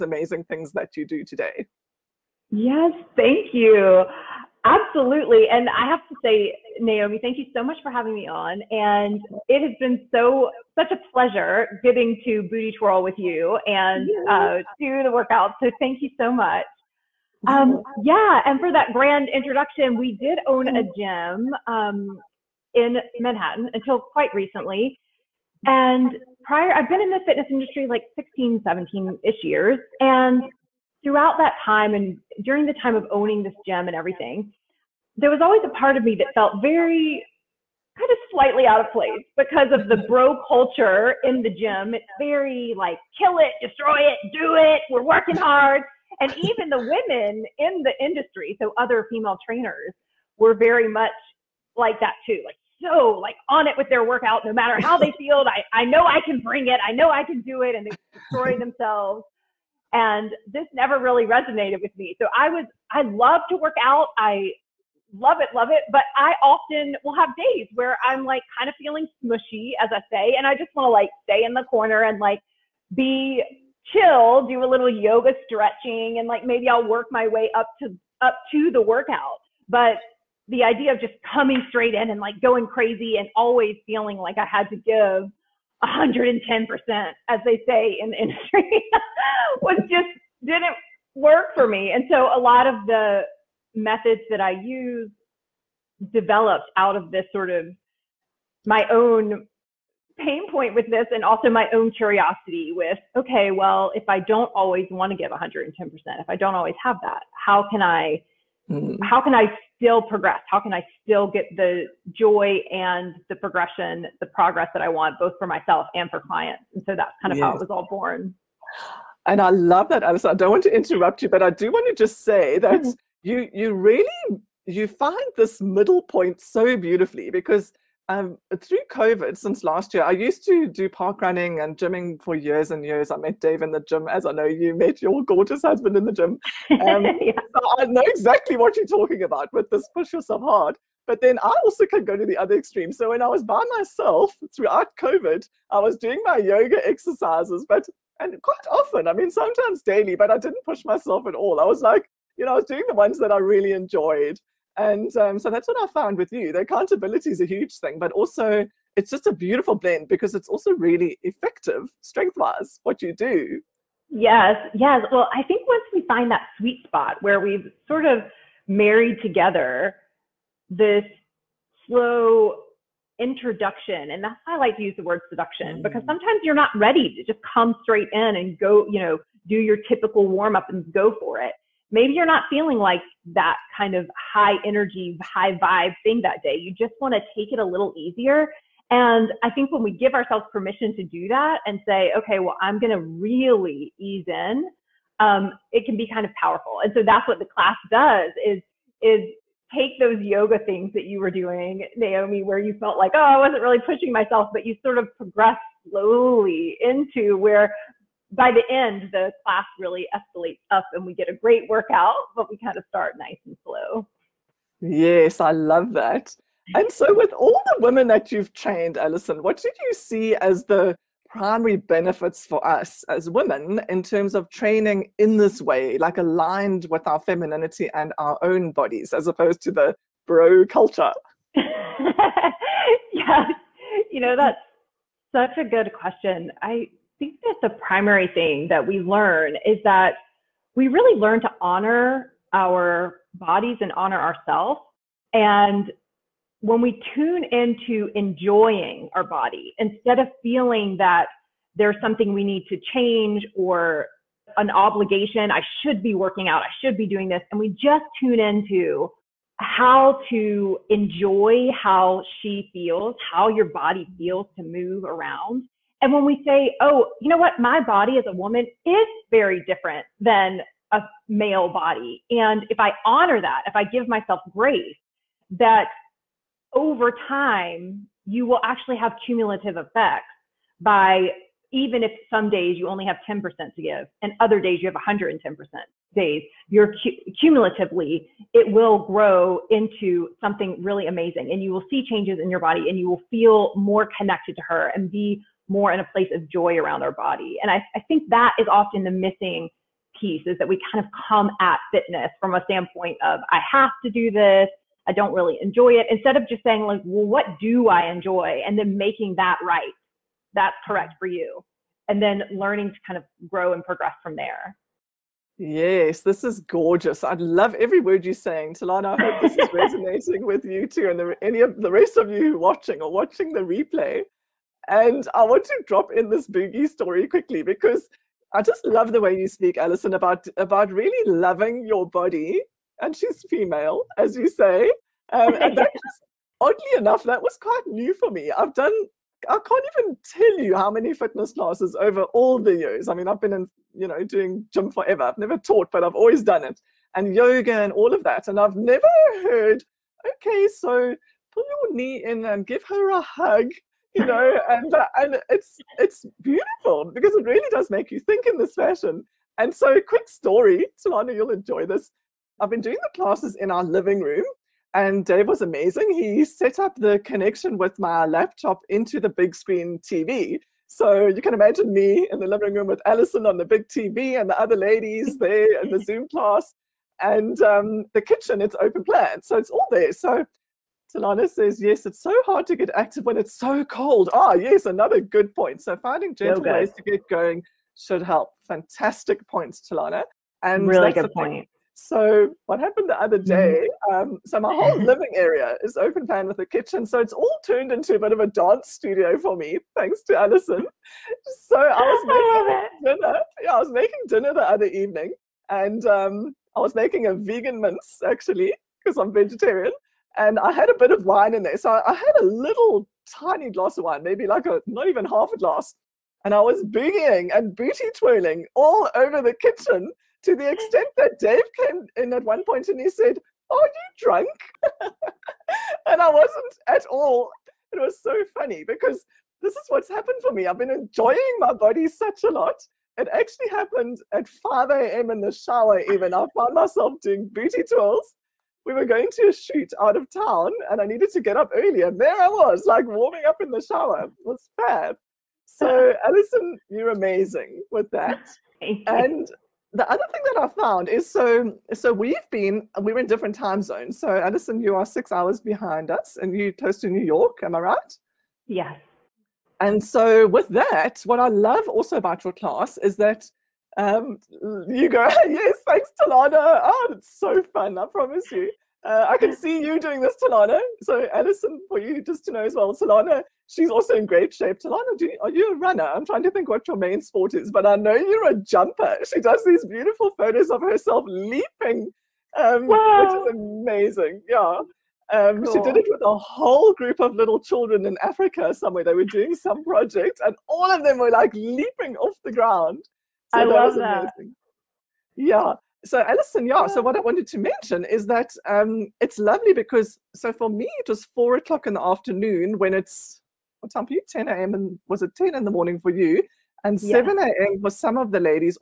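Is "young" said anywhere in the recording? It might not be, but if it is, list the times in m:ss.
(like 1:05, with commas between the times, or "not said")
not said.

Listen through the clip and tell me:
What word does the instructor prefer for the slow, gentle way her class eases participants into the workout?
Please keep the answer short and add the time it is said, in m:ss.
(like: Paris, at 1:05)
seduction, at 2:55.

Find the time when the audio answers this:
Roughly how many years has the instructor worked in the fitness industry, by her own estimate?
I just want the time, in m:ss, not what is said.
0:28.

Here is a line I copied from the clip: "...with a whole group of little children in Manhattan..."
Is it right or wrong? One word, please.
wrong.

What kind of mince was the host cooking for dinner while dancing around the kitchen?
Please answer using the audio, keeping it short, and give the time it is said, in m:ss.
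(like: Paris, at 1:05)
vegan mince, at 6:47.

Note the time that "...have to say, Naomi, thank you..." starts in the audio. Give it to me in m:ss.
0:05.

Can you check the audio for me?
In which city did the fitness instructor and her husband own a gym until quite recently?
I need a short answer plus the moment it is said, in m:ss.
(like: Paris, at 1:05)
Manhattan, at 0:23.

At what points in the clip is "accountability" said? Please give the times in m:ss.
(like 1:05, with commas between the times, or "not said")
2:36.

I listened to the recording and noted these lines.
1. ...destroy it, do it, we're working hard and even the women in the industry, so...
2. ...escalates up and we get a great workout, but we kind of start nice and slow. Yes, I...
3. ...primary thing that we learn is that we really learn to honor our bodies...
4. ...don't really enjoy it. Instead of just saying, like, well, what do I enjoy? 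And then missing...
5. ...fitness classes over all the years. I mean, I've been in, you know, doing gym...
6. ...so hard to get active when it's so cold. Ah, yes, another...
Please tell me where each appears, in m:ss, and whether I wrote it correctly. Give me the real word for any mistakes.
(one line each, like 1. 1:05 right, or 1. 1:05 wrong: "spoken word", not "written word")
1. 0:43 right
2. 3:30 right
3. 3:57 right
4. 5:05 wrong: "making", not "missing"
5. 5:41 right
6. 6:22 right.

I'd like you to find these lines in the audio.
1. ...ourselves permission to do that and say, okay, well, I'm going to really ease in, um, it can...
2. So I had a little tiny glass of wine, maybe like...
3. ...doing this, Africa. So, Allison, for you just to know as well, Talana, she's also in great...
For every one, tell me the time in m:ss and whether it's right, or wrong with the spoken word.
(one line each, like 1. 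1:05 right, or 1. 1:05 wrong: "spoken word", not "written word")
1. 3:10 right
2. 6:51 right
3. 7:50 wrong: "Talana", not "Africa".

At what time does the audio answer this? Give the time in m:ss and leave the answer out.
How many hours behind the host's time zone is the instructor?
7:35.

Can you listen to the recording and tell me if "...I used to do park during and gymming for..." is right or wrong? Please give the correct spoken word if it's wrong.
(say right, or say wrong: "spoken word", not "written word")
wrong: "running", not "during".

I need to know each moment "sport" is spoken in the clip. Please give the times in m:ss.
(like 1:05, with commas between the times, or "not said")
7:57.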